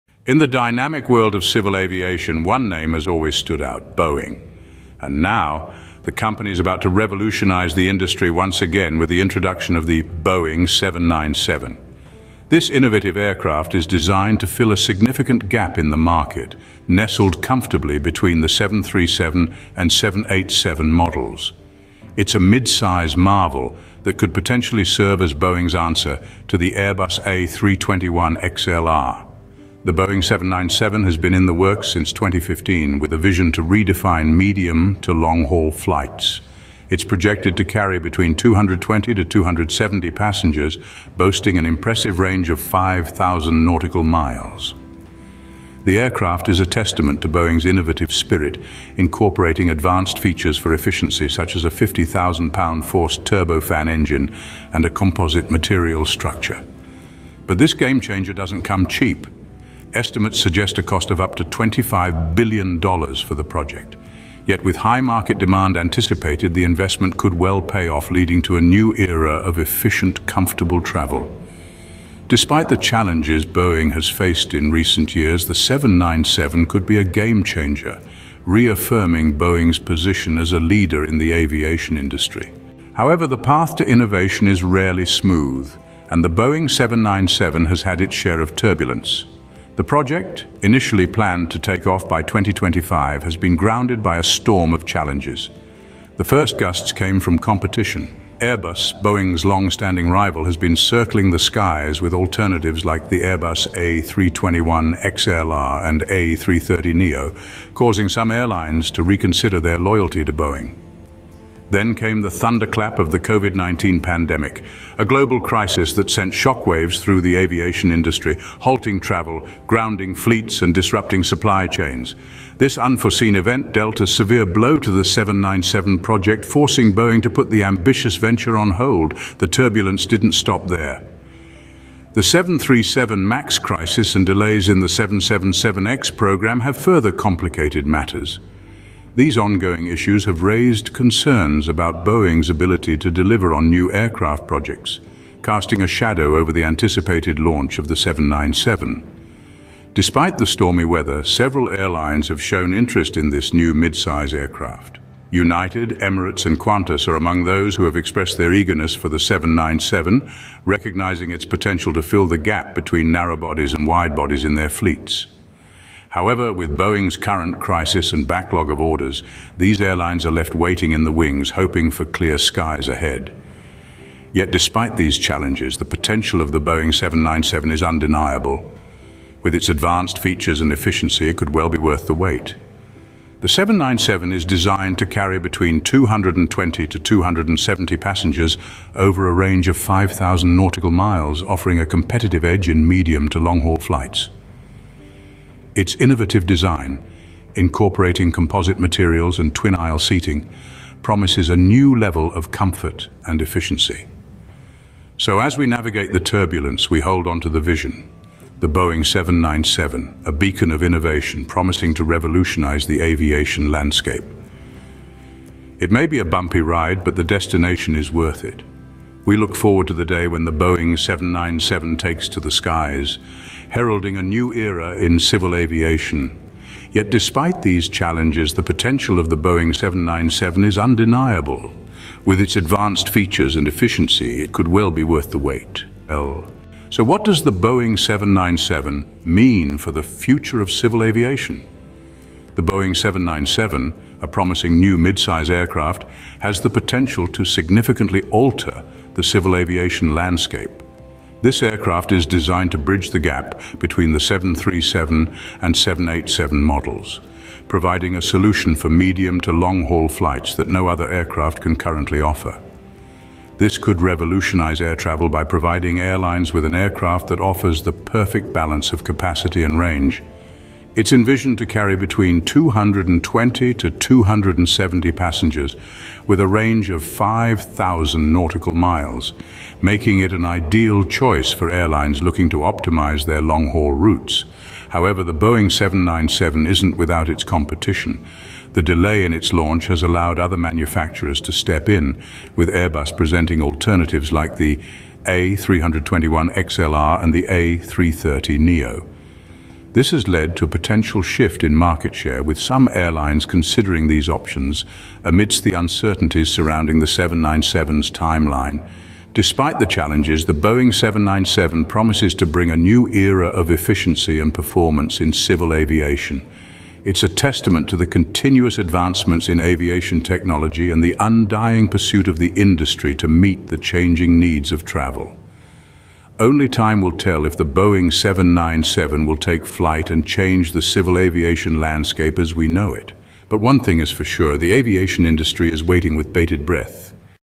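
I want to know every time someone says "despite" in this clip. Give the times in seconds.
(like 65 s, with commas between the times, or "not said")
72 s, 149 s, 174 s, 227 s, 309 s.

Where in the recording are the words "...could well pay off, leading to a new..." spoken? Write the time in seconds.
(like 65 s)
67 s.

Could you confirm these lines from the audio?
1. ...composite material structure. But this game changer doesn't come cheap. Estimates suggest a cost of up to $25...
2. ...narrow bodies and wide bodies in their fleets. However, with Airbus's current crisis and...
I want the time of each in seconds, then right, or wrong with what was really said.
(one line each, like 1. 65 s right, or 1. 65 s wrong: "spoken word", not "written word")
1. 54 s right
2. 163 s wrong: "Boeing", not "Airbus".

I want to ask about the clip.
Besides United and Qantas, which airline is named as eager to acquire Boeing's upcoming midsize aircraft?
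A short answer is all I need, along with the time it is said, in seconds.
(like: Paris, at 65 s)
Emirates, at 155 s.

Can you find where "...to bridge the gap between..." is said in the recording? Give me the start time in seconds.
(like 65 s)
252 s.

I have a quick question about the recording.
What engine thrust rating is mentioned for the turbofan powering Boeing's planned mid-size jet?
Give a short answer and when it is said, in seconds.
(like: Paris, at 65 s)
50,000-pound force, at 51 s.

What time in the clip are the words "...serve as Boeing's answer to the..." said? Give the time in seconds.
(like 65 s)
24 s.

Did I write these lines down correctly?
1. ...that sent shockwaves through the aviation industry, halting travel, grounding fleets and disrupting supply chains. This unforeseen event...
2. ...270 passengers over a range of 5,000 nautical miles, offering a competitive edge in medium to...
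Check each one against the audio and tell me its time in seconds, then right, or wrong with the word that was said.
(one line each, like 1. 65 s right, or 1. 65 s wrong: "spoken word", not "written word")
1. 115 s right
2. 186 s right.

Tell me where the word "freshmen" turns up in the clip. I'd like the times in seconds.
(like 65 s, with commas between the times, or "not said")
not said.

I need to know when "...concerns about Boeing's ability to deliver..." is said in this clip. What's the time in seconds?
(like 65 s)
140 s.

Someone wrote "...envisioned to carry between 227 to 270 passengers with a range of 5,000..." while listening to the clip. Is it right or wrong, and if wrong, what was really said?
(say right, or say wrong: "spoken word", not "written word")
wrong: "220", not "227".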